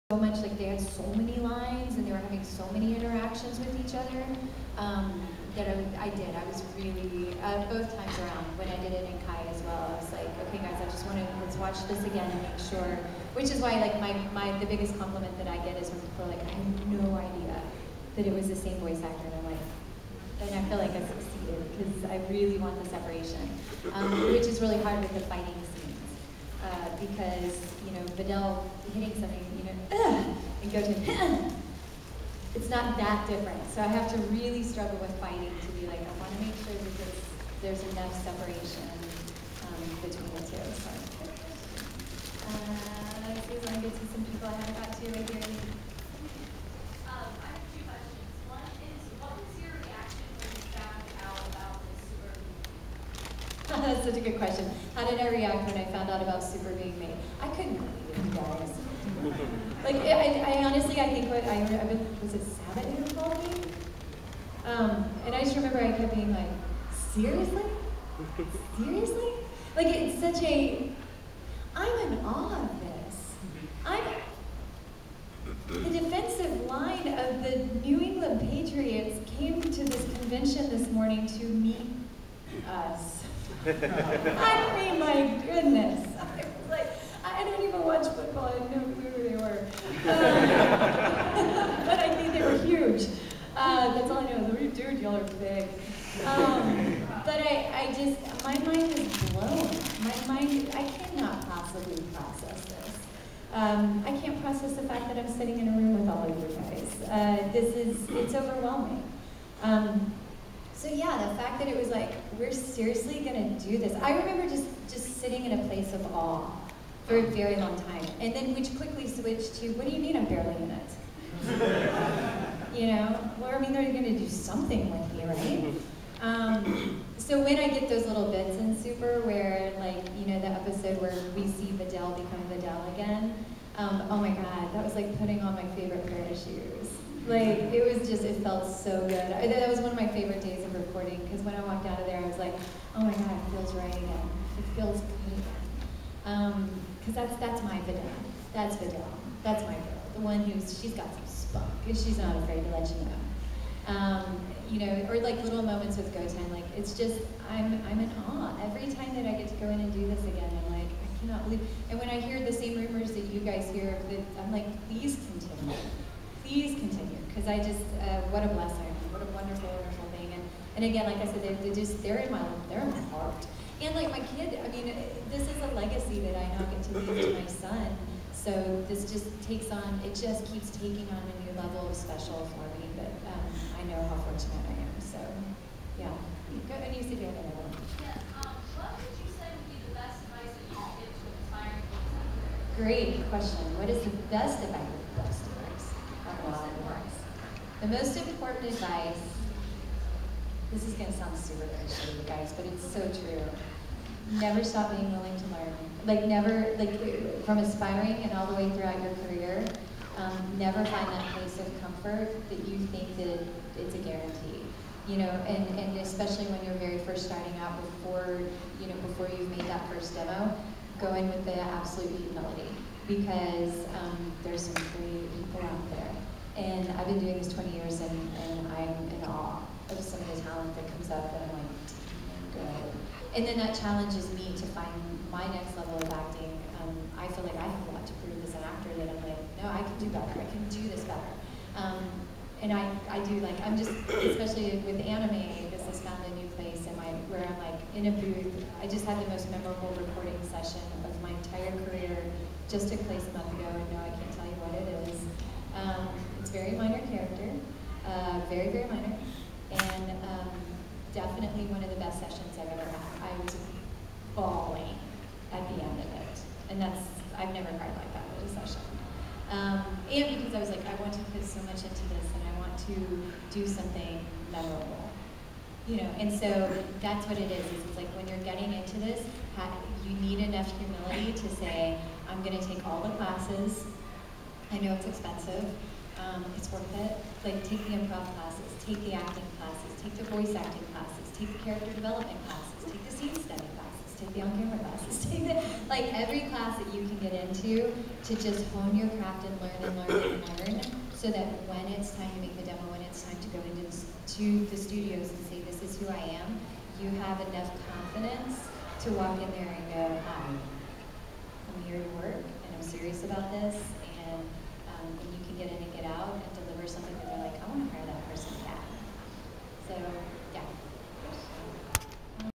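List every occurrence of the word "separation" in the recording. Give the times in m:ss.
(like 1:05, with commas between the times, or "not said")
0:22, 0:38.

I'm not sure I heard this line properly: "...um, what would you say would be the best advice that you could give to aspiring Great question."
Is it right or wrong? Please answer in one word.
right.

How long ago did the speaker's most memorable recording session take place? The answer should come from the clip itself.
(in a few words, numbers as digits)
A month ago.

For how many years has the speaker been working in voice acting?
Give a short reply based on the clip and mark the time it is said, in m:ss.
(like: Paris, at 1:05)
20, at 3:47.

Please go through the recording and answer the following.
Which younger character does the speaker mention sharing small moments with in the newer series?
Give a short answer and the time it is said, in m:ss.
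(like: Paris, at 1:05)
Goten, at 2:36.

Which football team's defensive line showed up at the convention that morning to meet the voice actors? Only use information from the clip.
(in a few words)
New England Patriots.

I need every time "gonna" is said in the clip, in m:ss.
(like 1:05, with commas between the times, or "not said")
1:53, 2:03, 3:20, 4:42.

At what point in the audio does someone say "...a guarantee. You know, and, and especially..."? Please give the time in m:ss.
3:33.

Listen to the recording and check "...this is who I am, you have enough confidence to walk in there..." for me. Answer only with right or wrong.
right.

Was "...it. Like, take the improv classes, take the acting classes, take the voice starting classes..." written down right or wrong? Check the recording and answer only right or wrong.
wrong.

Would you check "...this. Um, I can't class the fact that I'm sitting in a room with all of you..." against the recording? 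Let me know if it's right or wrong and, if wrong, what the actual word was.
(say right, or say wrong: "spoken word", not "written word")
wrong: "process", not "class".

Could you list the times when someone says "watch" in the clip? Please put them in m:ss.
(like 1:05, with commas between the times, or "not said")
0:11, 1:27.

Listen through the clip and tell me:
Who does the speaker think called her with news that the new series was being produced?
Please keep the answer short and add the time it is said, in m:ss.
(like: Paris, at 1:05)
Sabat, at 1:02.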